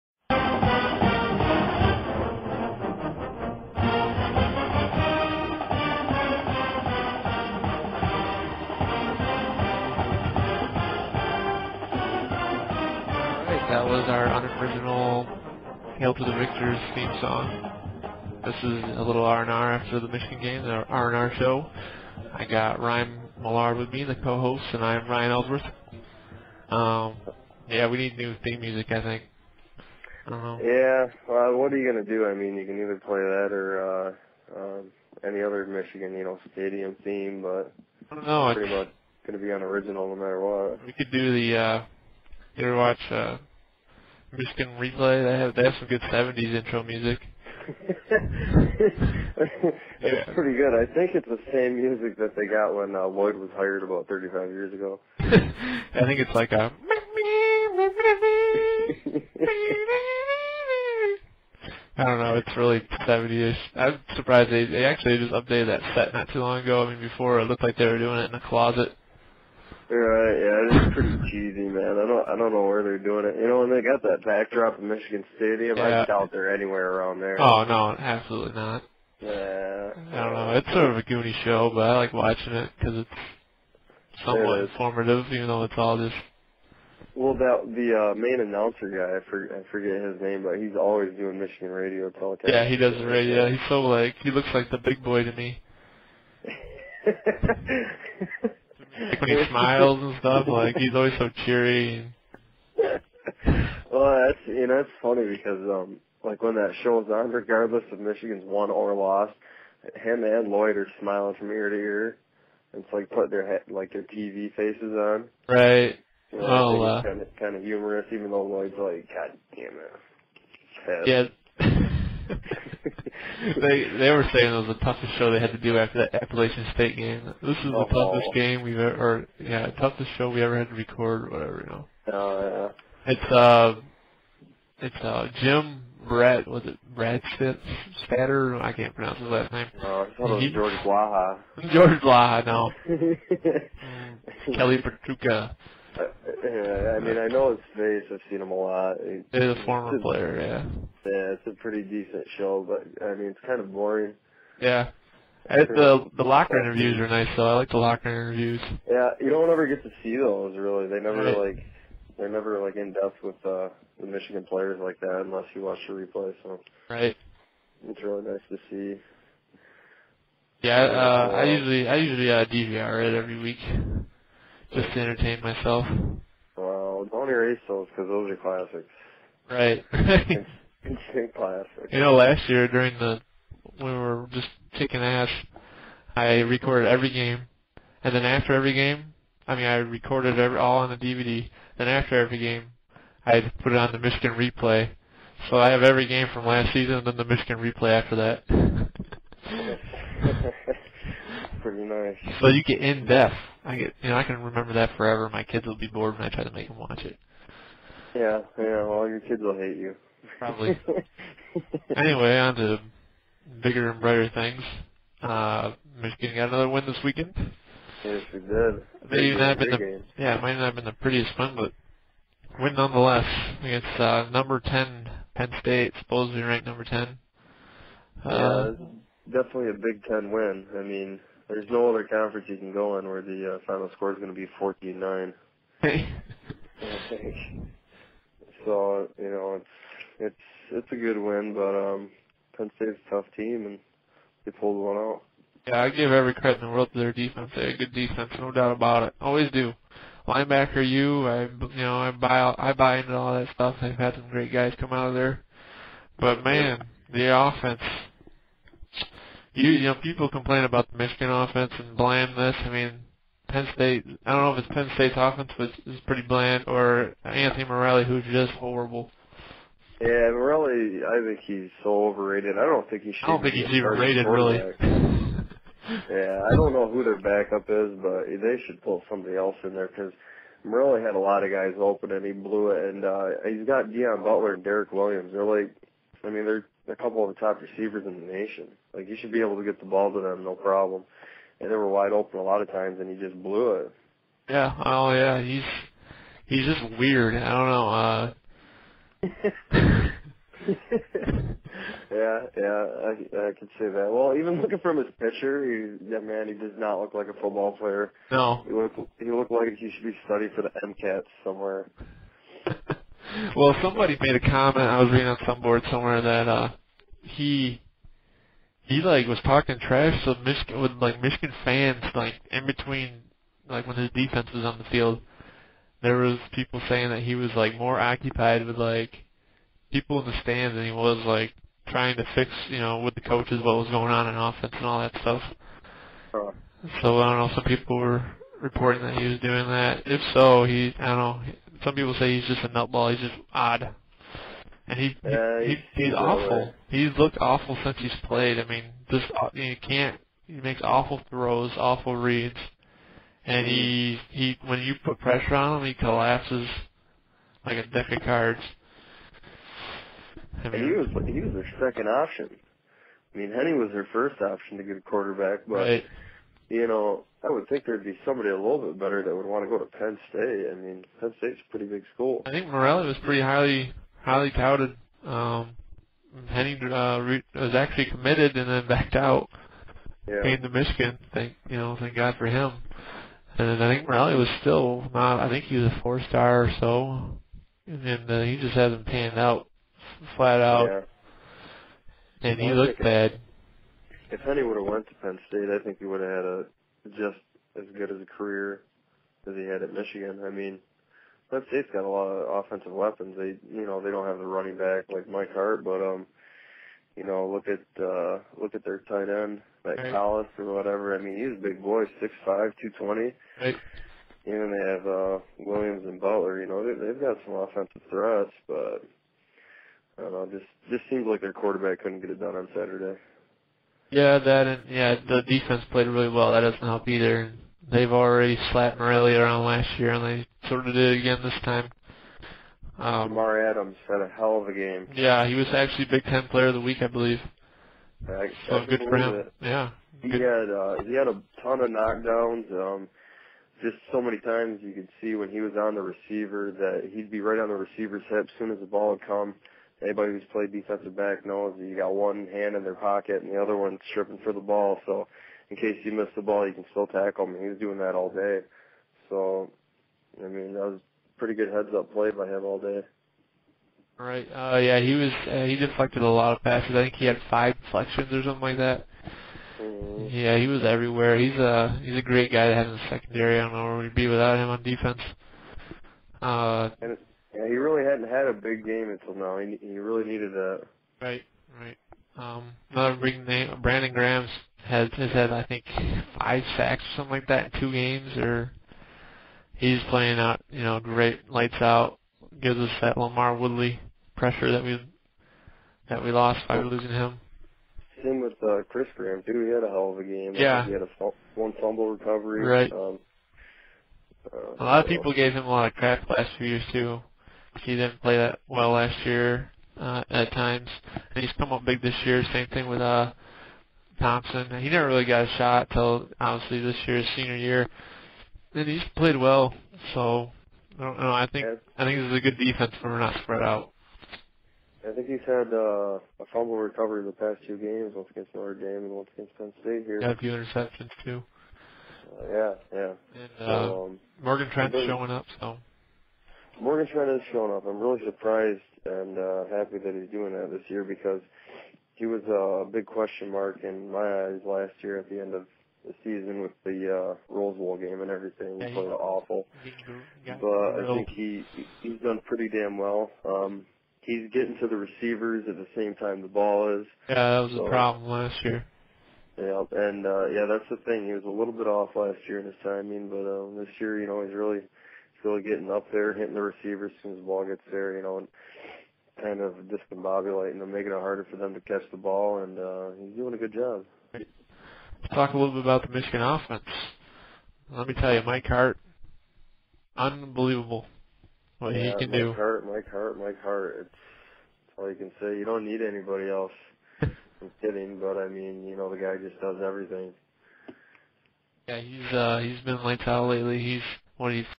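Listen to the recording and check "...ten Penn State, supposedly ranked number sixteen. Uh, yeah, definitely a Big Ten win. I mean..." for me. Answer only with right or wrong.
wrong.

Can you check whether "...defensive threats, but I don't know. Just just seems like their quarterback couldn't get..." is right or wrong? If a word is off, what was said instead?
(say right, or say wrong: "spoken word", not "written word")
wrong: "offensive", not "defensive".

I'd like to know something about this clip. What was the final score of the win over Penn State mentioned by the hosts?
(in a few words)
14-9.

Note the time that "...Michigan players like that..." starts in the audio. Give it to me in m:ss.
2:44.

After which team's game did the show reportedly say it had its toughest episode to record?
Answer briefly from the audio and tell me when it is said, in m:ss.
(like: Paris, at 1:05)
Appalachian State, at 2:06.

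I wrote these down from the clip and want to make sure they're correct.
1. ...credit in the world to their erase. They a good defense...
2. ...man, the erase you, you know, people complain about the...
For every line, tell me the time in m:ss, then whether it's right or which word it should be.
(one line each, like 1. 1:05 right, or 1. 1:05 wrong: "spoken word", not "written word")
1. 4:06 wrong: "defense", not "erase"
2. 4:16 wrong: "offense", not "erase".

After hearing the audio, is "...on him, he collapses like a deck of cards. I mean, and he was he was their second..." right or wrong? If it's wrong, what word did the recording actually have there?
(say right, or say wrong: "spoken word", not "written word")
right.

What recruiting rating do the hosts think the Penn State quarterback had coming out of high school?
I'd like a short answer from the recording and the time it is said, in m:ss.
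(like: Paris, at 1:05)
Four star, at 6:26.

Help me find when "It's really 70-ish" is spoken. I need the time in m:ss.
1:02.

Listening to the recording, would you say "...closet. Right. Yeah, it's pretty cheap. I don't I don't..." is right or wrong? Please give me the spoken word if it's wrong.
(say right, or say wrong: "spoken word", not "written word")
right.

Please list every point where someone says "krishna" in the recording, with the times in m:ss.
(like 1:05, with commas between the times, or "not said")
not said.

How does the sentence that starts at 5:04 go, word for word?
Well, even looking from his picture, he, that man, he does not look like a football player.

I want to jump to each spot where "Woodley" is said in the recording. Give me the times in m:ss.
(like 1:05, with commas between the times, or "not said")
8:13.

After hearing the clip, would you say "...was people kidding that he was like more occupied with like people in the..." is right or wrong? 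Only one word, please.
wrong.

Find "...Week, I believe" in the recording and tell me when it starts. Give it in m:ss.
7:16.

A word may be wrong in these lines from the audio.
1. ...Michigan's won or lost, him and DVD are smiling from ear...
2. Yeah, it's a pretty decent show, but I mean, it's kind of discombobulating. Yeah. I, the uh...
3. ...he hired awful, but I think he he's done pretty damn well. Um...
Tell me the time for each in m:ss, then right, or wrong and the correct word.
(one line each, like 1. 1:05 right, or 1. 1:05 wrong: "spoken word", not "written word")
1. 1:47 wrong: "Lloyd", not "DVD"
2. 2:31 wrong: "boring", not "discombobulating"
3. 9:08 wrong: "played", not "hired".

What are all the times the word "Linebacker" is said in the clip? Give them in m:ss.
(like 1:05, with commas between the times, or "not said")
4:10.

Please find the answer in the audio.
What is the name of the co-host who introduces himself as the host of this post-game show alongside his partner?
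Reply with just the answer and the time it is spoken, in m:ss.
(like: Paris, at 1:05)
Ryan Ellsworth, at 0:25.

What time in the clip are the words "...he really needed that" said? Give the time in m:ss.
7:59.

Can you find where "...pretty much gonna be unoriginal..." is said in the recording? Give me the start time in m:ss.
0:38.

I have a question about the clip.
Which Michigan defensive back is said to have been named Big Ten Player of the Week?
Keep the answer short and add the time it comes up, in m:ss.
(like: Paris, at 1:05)
Jamar Adams, at 7:13.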